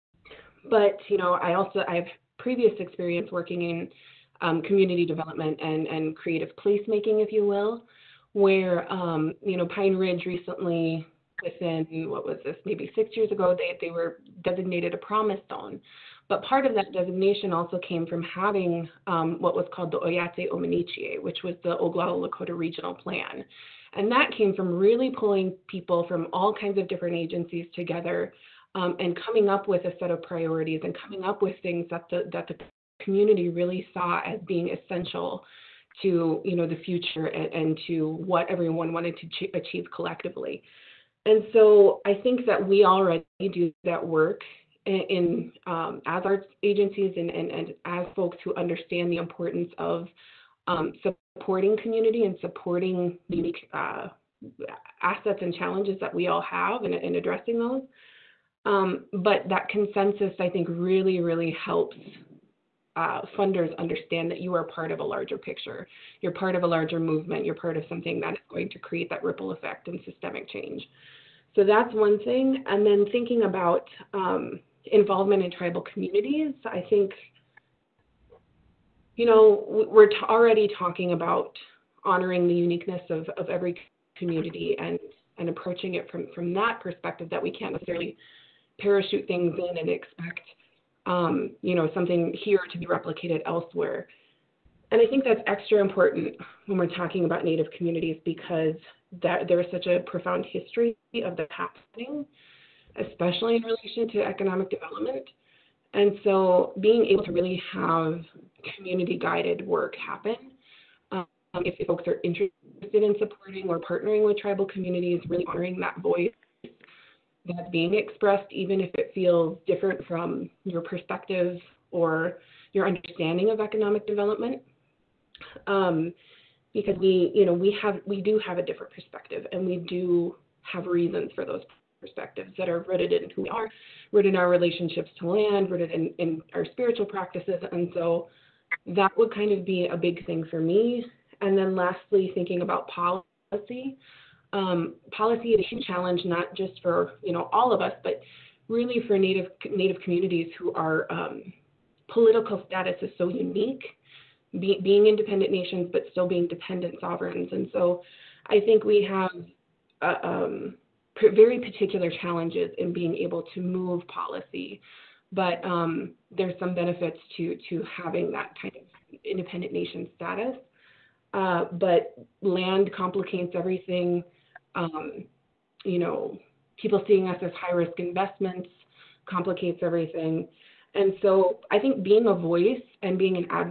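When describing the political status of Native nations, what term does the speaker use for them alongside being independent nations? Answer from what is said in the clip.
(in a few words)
Dependent sovereigns.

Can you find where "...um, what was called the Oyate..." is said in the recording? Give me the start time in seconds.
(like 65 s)
19 s.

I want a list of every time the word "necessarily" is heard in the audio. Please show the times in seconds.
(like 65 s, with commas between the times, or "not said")
87 s.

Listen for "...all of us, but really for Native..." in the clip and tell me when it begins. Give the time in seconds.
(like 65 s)
147 s.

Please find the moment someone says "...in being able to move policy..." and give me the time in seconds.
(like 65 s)
162 s.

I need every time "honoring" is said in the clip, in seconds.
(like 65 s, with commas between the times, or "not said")
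82 s, 115 s.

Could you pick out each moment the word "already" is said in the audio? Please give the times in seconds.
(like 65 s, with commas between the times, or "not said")
42 s, 80 s.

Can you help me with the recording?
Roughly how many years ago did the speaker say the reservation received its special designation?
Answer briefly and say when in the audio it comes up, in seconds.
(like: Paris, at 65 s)
6, at 12 s.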